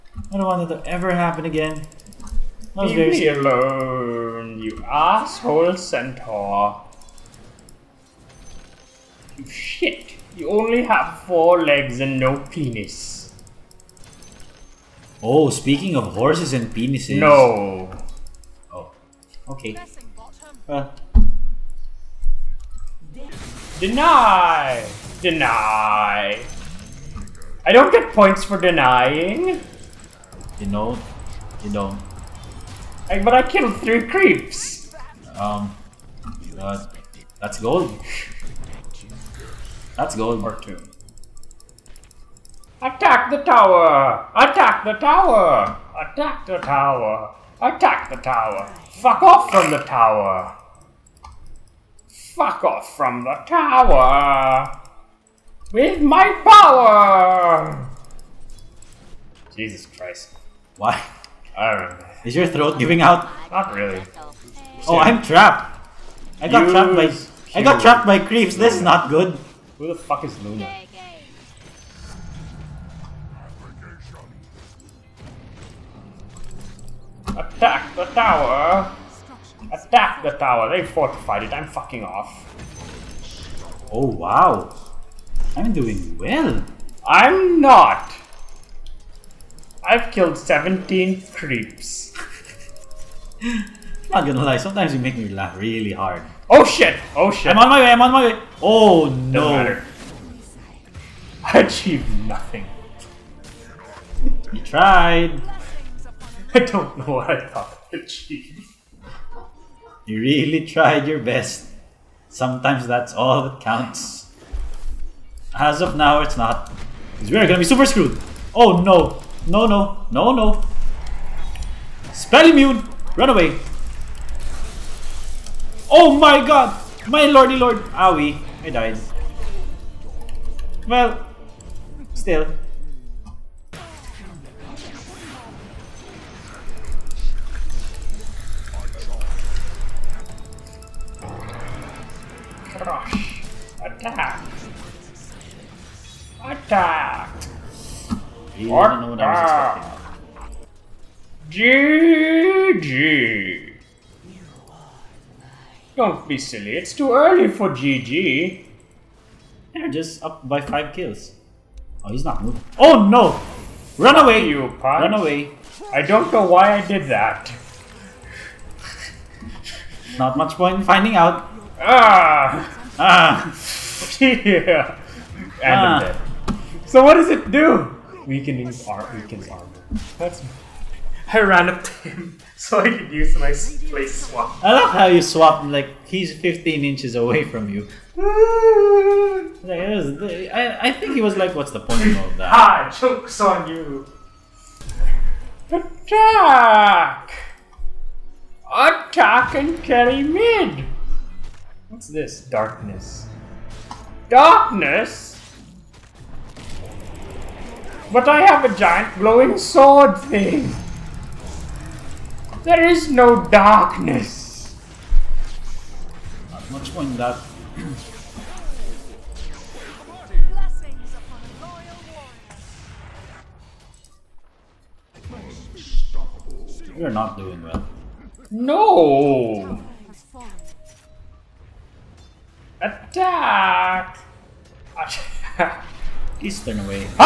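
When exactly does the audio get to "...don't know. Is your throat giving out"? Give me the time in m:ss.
1:01.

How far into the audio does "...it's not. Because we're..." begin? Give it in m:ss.
1:56.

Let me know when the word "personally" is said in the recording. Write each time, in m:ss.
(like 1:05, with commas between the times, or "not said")
not said.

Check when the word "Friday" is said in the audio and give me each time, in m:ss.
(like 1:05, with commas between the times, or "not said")
not said.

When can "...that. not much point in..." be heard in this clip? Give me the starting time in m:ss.
2:47.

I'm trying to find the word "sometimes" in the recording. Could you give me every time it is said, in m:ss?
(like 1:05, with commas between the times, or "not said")
1:34, 1:52.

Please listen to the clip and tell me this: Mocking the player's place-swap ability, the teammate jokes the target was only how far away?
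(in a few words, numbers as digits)
15 inches.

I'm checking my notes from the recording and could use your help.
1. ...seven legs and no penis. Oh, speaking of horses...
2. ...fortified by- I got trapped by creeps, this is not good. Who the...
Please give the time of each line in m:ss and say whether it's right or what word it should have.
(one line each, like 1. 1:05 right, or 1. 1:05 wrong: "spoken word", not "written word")
1. 0:11 wrong: "four", not "seven"
2. 1:07 wrong: "trapped", not "fortified".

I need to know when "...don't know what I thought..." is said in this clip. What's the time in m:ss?
1:46.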